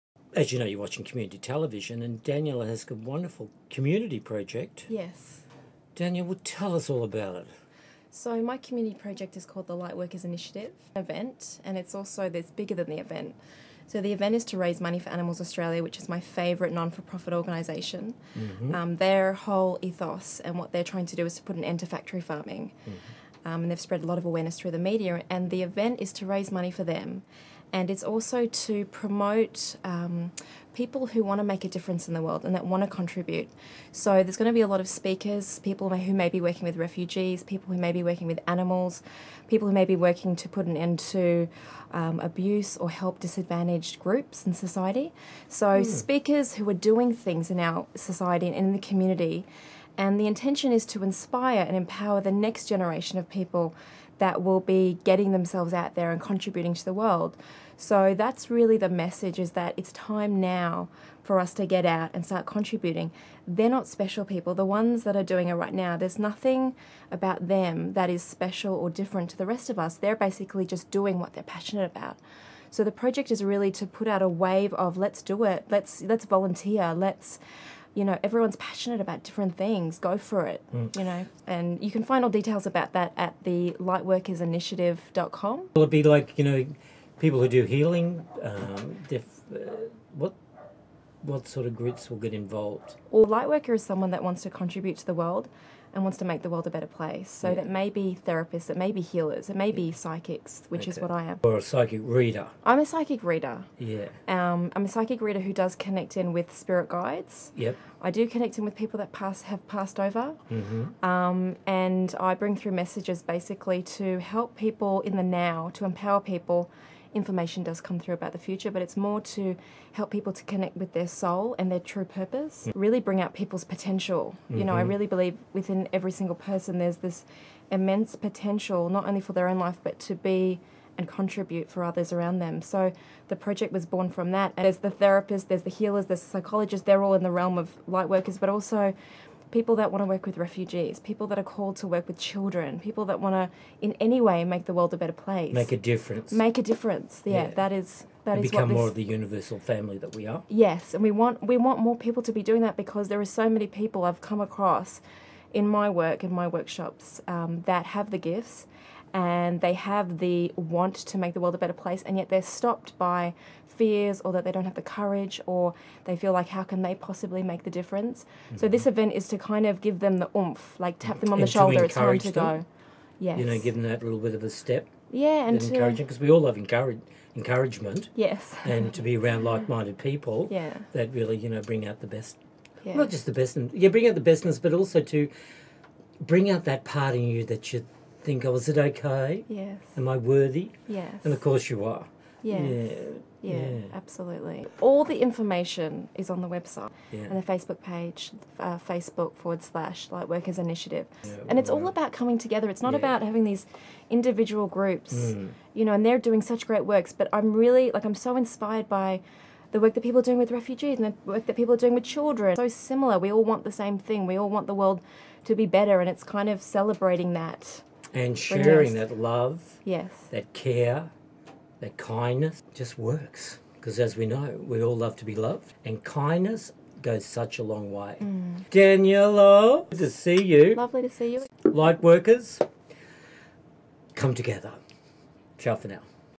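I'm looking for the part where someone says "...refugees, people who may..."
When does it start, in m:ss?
0:36.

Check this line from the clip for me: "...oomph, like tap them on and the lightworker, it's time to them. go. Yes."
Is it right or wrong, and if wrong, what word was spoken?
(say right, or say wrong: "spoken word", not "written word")
wrong: "shoulder", not "lightworker".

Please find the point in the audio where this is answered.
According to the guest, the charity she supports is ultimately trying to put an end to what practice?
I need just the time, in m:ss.
0:21.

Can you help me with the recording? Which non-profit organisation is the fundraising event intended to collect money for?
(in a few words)
Animals Australia.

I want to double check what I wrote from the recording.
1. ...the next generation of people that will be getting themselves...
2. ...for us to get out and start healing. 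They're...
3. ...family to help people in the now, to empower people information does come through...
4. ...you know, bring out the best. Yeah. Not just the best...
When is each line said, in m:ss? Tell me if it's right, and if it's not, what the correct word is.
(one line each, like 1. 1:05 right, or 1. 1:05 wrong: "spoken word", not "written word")
1. 0:52 right
2. 1:01 wrong: "contributing", not "healing"
3. 1:53 wrong: "basically", not "family"
4. 3:01 right.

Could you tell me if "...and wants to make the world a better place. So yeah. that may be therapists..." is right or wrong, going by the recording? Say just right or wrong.
right.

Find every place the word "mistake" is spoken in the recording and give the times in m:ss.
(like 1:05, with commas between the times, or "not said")
not said.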